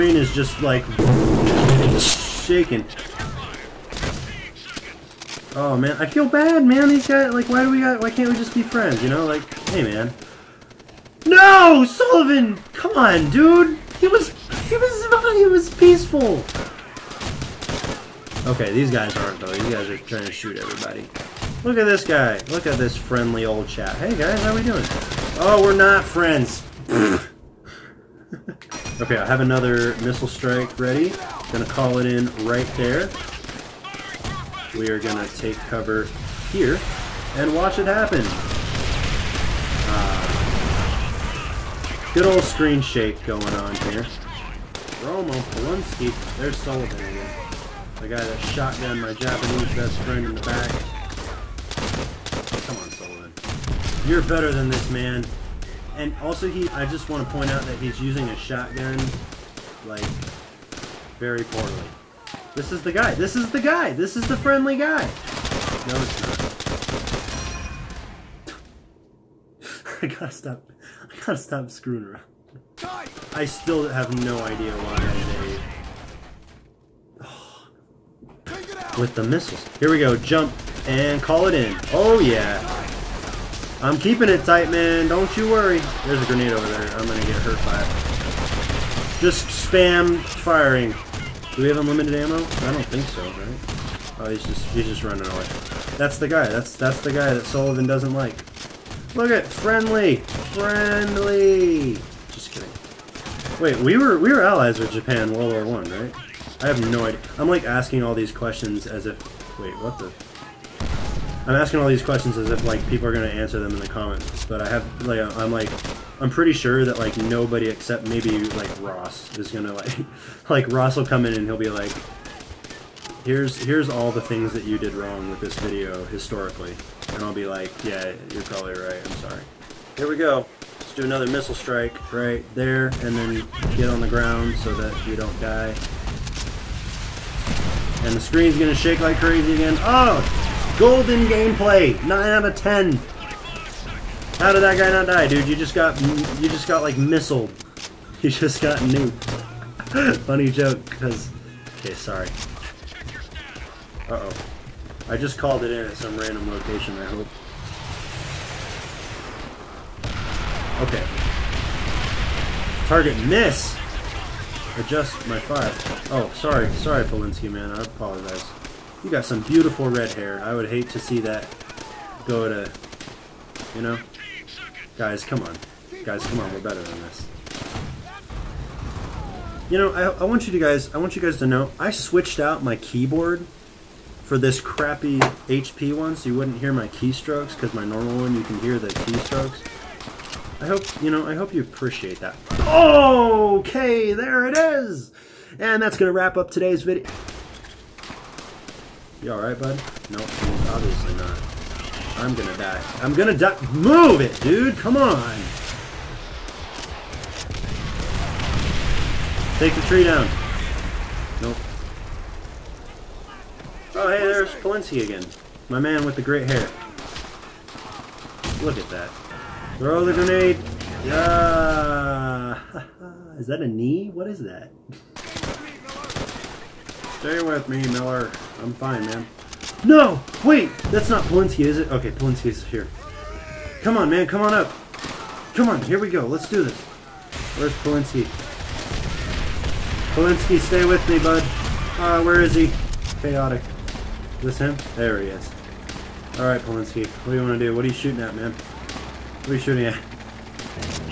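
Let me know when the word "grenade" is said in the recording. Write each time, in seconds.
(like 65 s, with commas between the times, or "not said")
86 s, 220 s.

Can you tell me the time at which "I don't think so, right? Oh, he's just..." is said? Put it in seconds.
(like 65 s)
92 s.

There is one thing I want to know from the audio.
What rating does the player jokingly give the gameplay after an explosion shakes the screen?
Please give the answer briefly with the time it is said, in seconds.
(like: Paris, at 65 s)
9 out of 10, at 142 s.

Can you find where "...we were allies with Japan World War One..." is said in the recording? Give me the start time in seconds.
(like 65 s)
104 s.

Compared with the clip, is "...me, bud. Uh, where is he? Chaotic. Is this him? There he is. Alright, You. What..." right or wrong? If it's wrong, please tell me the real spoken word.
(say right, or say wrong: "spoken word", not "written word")
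wrong: "Polonsky", not "You".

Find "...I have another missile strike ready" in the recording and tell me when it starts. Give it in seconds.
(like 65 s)
29 s.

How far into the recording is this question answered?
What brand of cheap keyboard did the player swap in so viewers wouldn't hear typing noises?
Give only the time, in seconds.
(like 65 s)
185 s.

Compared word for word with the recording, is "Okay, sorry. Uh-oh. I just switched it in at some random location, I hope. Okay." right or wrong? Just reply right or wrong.
wrong.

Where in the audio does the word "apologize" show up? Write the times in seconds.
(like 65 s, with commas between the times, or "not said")
167 s.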